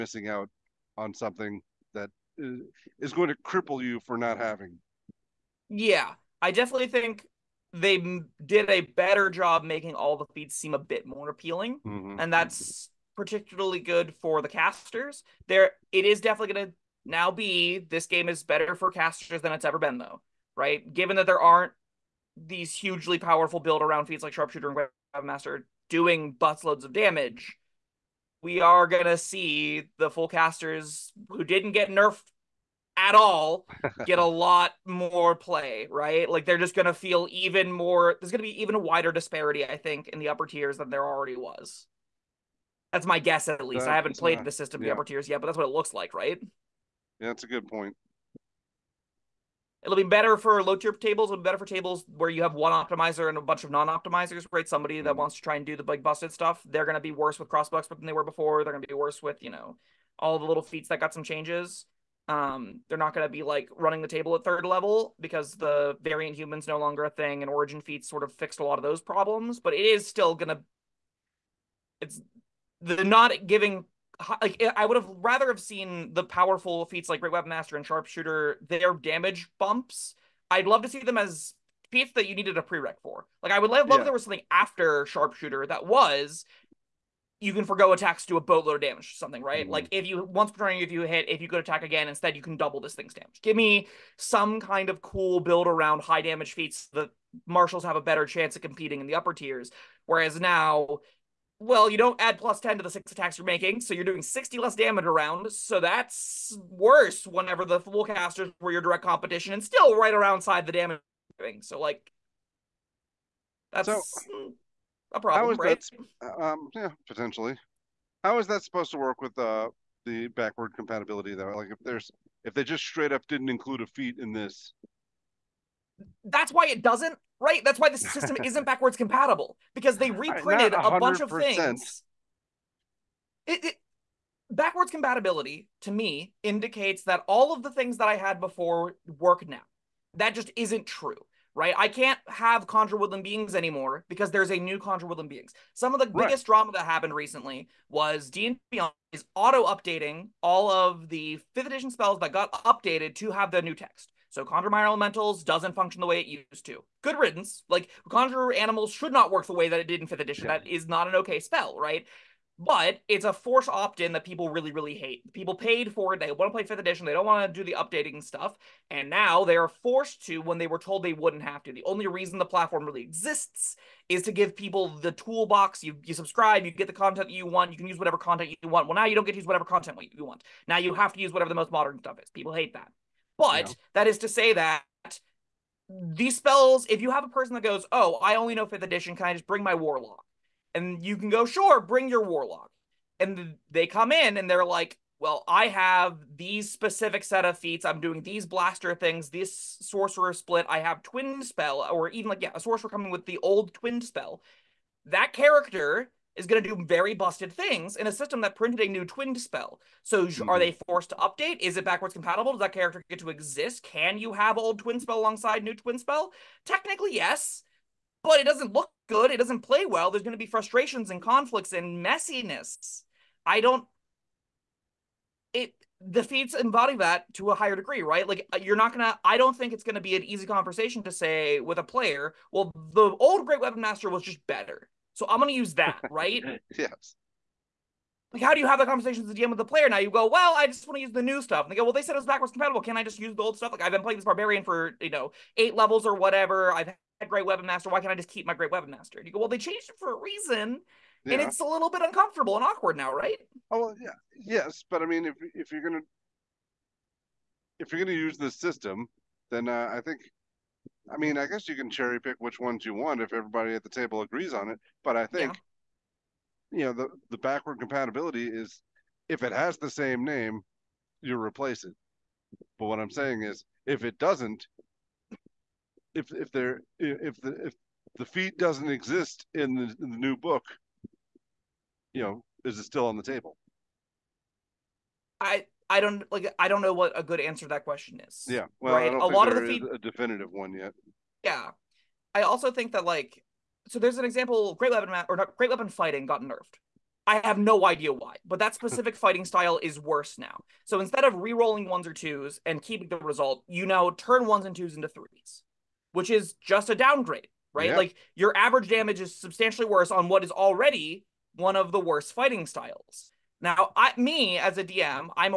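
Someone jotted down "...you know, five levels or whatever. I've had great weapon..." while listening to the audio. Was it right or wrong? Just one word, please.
wrong.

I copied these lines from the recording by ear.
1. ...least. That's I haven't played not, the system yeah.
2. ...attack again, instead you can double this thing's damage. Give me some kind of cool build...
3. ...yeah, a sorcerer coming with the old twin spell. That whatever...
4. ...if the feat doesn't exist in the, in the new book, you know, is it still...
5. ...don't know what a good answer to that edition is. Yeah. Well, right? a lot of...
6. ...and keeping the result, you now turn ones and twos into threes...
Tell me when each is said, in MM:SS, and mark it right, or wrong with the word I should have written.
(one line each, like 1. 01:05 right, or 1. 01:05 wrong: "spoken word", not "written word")
1. 00:43 right
2. 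01:31 right
3. 03:22 wrong: "character", not "whatever"
4. 04:37 right
5. 04:46 wrong: "question", not "edition"
6. 05:02 right.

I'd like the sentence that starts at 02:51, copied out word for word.
The only reason the platform really exists is to give people the toolbox.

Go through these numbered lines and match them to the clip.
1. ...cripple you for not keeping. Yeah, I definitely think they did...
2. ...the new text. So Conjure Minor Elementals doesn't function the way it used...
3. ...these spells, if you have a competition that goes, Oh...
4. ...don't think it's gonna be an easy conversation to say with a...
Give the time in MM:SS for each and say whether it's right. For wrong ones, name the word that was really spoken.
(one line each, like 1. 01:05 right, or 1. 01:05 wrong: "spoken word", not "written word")
1. 00:03 wrong: "having", not "keeping"
2. 02:33 right
3. 03:05 wrong: "person", not "competition"
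4. 03:49 right.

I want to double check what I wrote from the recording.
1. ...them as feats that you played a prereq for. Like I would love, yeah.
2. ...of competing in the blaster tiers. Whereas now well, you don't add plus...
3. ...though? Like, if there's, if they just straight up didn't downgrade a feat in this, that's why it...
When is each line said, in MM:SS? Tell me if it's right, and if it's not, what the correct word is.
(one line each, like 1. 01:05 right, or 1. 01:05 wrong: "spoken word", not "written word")
1. 01:20 wrong: "needed", not "played"
2. 01:38 wrong: "upper", not "blaster"
3. 02:01 wrong: "include", not "downgrade".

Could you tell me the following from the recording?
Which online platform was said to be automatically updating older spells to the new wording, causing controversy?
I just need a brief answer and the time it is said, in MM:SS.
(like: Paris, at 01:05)
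D and Beyond, at 02:28.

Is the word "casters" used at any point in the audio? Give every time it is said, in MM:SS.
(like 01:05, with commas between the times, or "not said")
00:14, 00:18, 00:30, 01:48.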